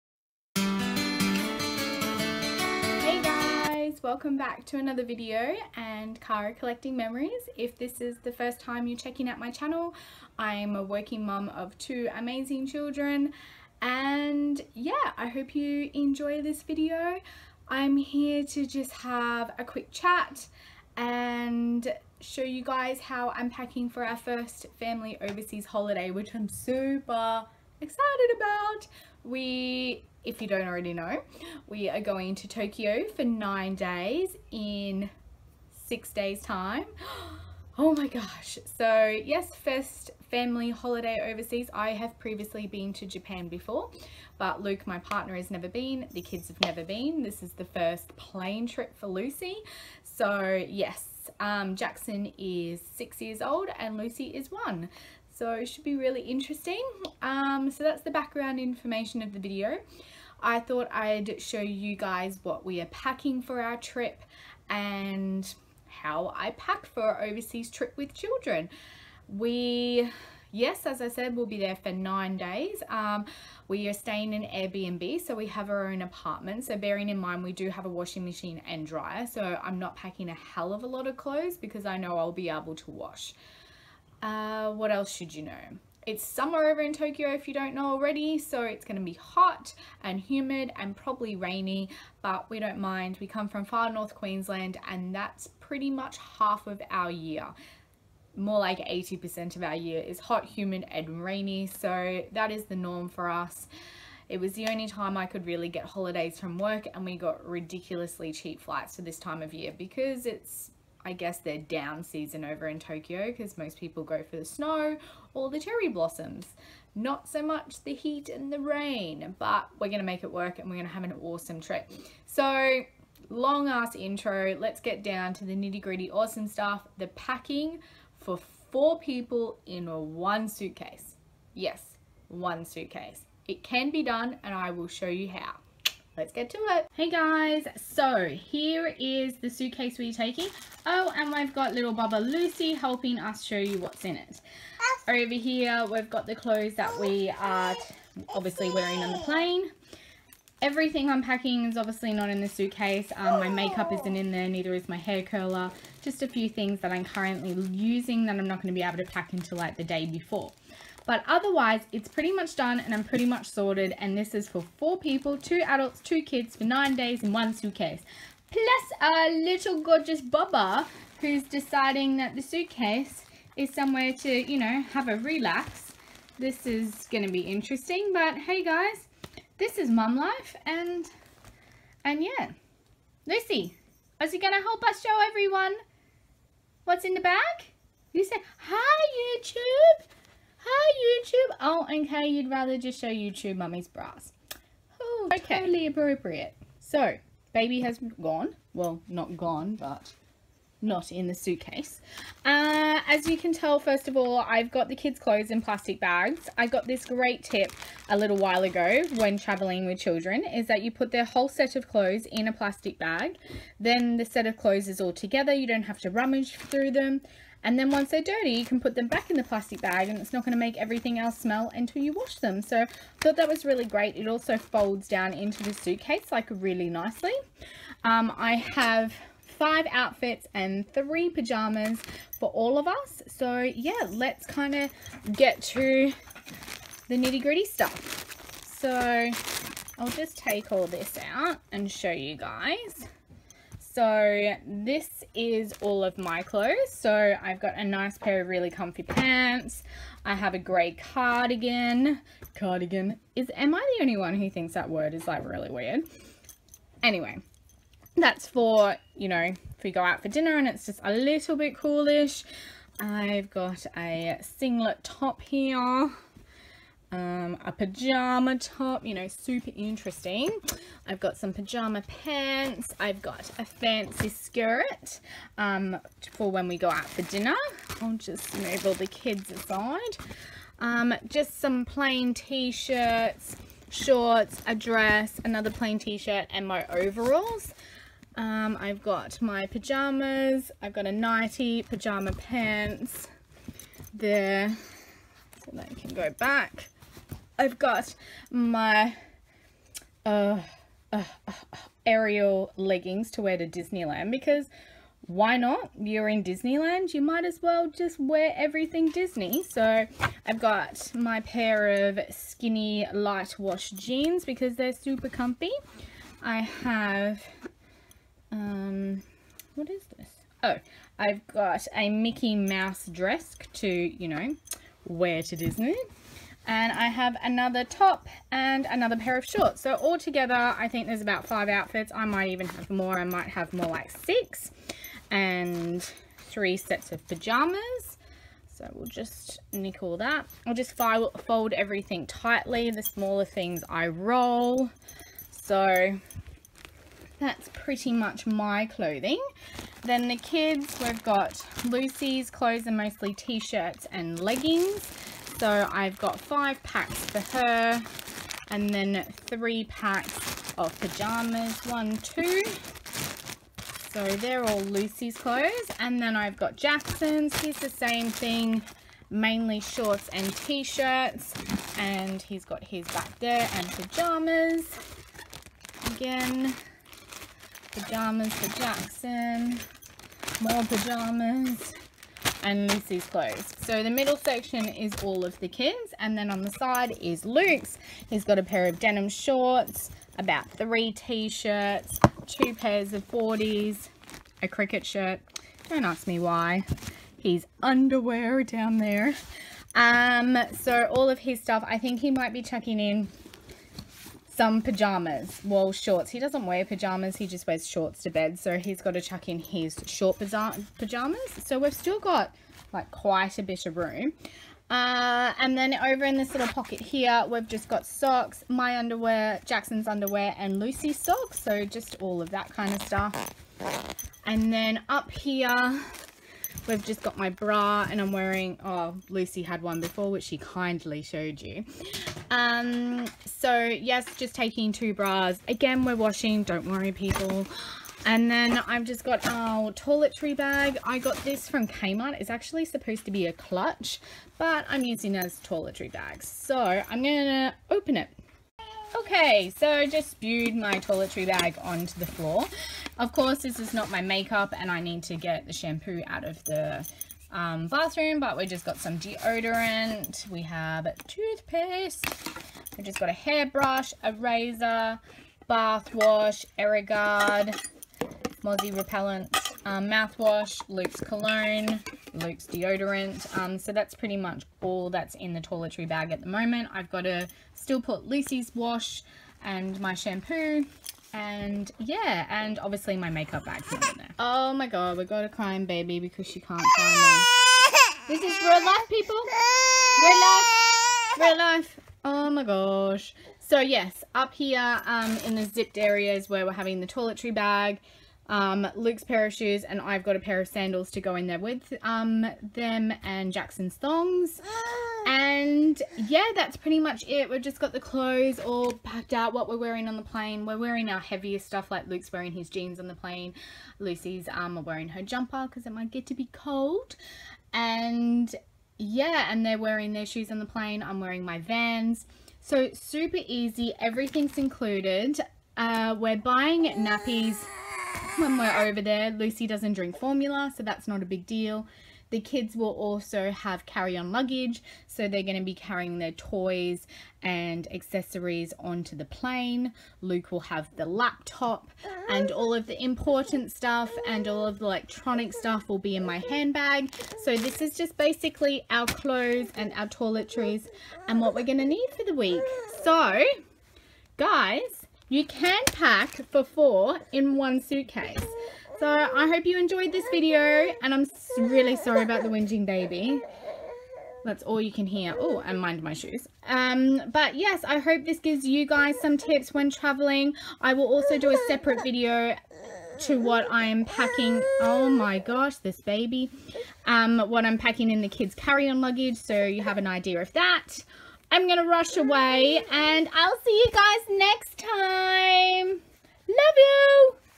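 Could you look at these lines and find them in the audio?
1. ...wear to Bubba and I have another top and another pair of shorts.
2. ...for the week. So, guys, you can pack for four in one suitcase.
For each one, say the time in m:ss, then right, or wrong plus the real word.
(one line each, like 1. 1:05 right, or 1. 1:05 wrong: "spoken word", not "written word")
1. 5:25 wrong: "Disney", not "Bubba"
2. 9:12 right.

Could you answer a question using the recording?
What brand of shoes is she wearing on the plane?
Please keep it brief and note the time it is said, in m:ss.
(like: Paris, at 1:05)
Vans, at 8:41.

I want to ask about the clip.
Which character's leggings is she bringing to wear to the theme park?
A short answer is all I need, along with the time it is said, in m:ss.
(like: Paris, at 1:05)
Ariel, at 5:02.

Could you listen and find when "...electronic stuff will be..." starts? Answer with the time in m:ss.
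9:04.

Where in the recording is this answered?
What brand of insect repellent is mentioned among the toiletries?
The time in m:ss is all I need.
7:46.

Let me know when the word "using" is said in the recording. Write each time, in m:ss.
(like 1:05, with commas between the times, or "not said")
2:37, 7:25.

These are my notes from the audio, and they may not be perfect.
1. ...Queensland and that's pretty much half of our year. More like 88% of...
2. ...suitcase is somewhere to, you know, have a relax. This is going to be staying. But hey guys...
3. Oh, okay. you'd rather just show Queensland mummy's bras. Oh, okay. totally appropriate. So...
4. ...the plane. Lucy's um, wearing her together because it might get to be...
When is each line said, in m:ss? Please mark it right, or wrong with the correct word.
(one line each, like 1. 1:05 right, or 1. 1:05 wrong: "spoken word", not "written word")
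1. 1:34 wrong: "80", not "88"
2. 2:52 wrong: "interesting", not "staying"
3. 3:11 wrong: "YouTube", not "Queensland"
4. 8:33 wrong: "jumper", not "together".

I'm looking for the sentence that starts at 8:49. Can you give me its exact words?
Lucy doesn't drink formula, so that's not a big deal.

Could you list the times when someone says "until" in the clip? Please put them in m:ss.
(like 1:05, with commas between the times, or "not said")
2:39, 3:41.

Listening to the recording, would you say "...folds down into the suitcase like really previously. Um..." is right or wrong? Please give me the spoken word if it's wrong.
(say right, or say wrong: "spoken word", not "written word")
wrong: "nicely", not "previously".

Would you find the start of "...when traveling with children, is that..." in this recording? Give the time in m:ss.
3:29.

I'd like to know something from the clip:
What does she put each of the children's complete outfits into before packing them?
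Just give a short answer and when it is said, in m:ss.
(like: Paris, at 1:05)
Plastic bags, at 3:25.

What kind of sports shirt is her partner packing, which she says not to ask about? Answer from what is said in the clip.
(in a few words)
Cricket shirt.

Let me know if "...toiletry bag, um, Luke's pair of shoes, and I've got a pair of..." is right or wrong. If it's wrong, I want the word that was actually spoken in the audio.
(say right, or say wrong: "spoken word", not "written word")
right.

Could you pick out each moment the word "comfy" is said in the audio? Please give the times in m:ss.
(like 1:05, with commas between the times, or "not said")
4:08, 5:15.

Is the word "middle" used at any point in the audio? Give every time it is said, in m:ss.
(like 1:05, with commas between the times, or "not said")
6:24.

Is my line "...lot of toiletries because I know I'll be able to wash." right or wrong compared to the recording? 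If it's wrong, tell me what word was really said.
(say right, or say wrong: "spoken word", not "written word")
wrong: "clothes", not "toiletries".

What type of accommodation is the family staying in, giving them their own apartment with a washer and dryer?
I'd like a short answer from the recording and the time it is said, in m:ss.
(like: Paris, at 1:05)
Airbnb, at 1:14.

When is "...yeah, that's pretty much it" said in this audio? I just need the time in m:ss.
8:26.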